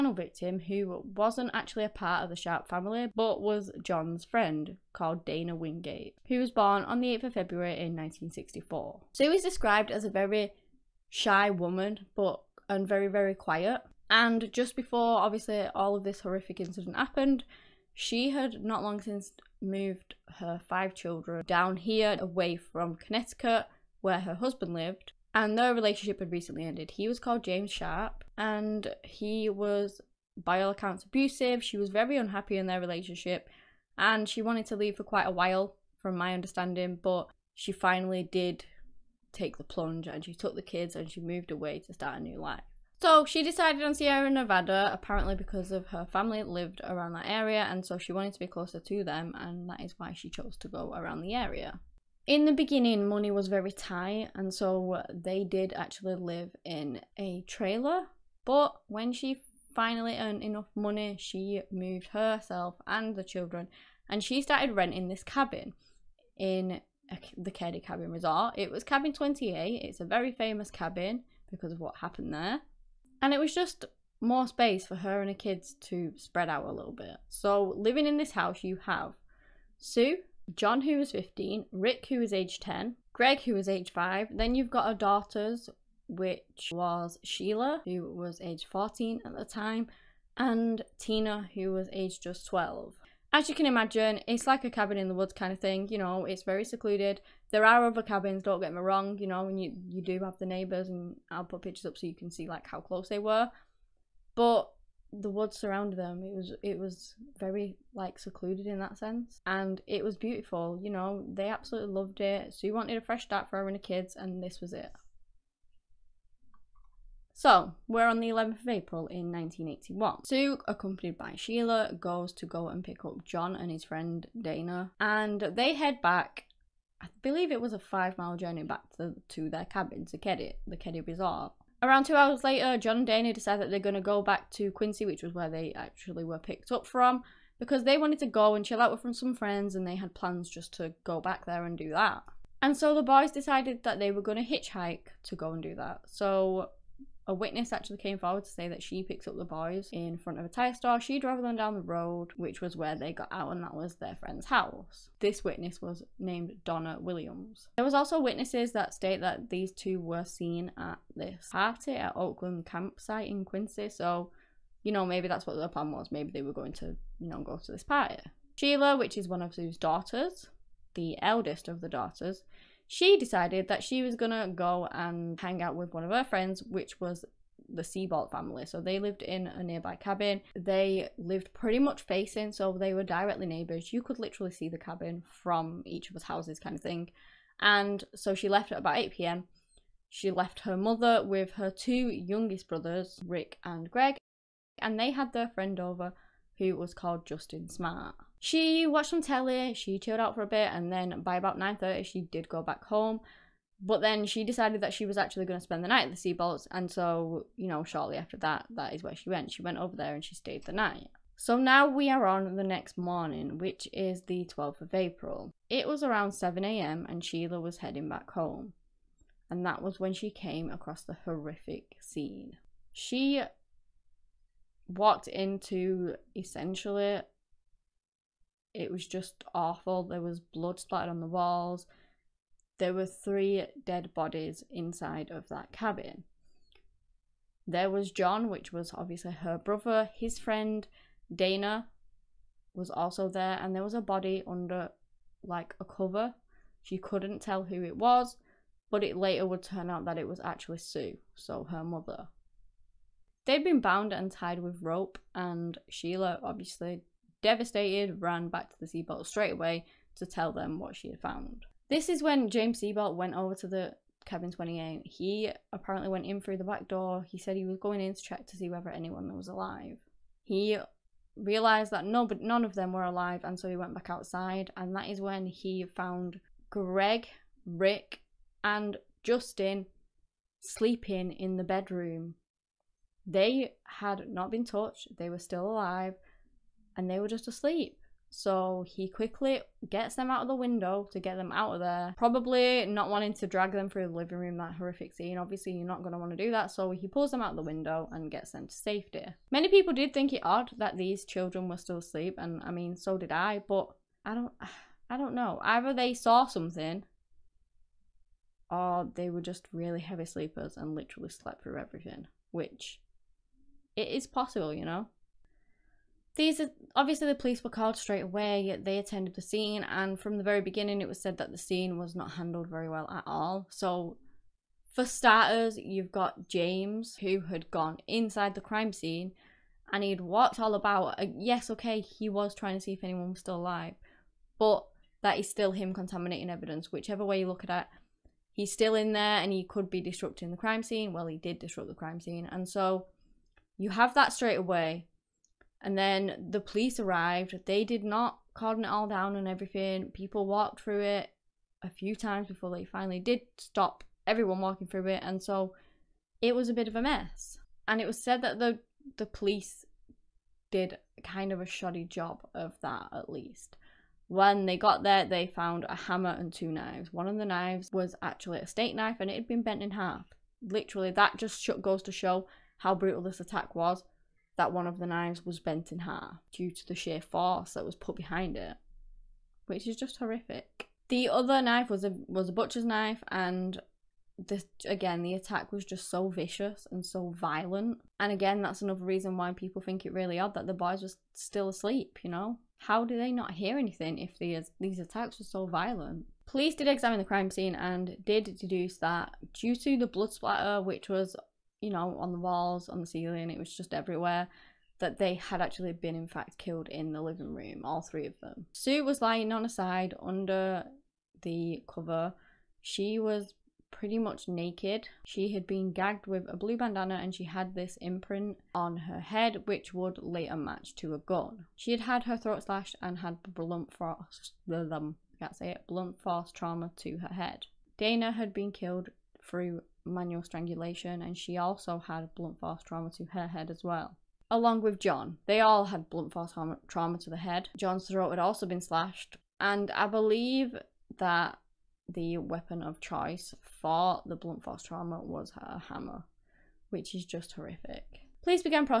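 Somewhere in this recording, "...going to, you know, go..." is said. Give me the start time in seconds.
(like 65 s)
166 s.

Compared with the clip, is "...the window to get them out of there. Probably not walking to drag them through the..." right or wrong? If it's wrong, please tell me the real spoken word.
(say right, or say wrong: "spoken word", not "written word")
wrong: "wanting", not "walking".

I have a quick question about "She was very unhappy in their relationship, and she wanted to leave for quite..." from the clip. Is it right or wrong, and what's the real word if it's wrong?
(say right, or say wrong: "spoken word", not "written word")
right.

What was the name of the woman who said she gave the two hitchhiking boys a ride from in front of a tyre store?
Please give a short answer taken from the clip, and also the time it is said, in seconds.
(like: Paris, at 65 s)
Donna Williams, at 156 s.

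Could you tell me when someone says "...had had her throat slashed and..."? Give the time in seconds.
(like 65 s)
421 s.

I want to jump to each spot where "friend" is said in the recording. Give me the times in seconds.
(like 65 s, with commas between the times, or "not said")
4 s, 123 s, 139 s, 154 s, 176 s, 195 s, 240 s.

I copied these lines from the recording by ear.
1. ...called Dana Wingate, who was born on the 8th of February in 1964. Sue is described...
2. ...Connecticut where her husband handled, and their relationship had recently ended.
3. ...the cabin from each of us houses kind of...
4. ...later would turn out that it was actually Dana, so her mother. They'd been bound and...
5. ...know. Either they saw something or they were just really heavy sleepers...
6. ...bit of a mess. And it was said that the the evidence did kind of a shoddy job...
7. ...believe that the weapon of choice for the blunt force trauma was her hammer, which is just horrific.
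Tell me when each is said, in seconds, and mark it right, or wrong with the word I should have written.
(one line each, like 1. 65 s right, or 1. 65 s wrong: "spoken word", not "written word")
1. 4 s right
2. 22 s wrong: "lived", not "handled"
3. 184 s right
4. 249 s wrong: "Sue", not "Dana"
5. 305 s right
6. 356 s wrong: "police", not "evidence"
7. 440 s right.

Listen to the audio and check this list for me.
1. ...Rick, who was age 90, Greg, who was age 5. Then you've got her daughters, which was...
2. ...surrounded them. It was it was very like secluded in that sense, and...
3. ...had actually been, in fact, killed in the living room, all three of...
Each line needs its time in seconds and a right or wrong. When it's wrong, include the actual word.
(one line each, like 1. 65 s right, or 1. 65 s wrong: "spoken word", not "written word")
1. 81 s wrong: "10", not "90"
2. 105 s right
3. 405 s right.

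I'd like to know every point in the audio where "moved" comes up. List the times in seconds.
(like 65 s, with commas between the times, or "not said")
19 s, 41 s, 61 s.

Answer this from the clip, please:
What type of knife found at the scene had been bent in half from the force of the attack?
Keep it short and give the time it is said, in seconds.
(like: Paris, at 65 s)
Steak knife, at 368 s.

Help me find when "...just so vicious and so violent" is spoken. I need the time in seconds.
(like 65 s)
385 s.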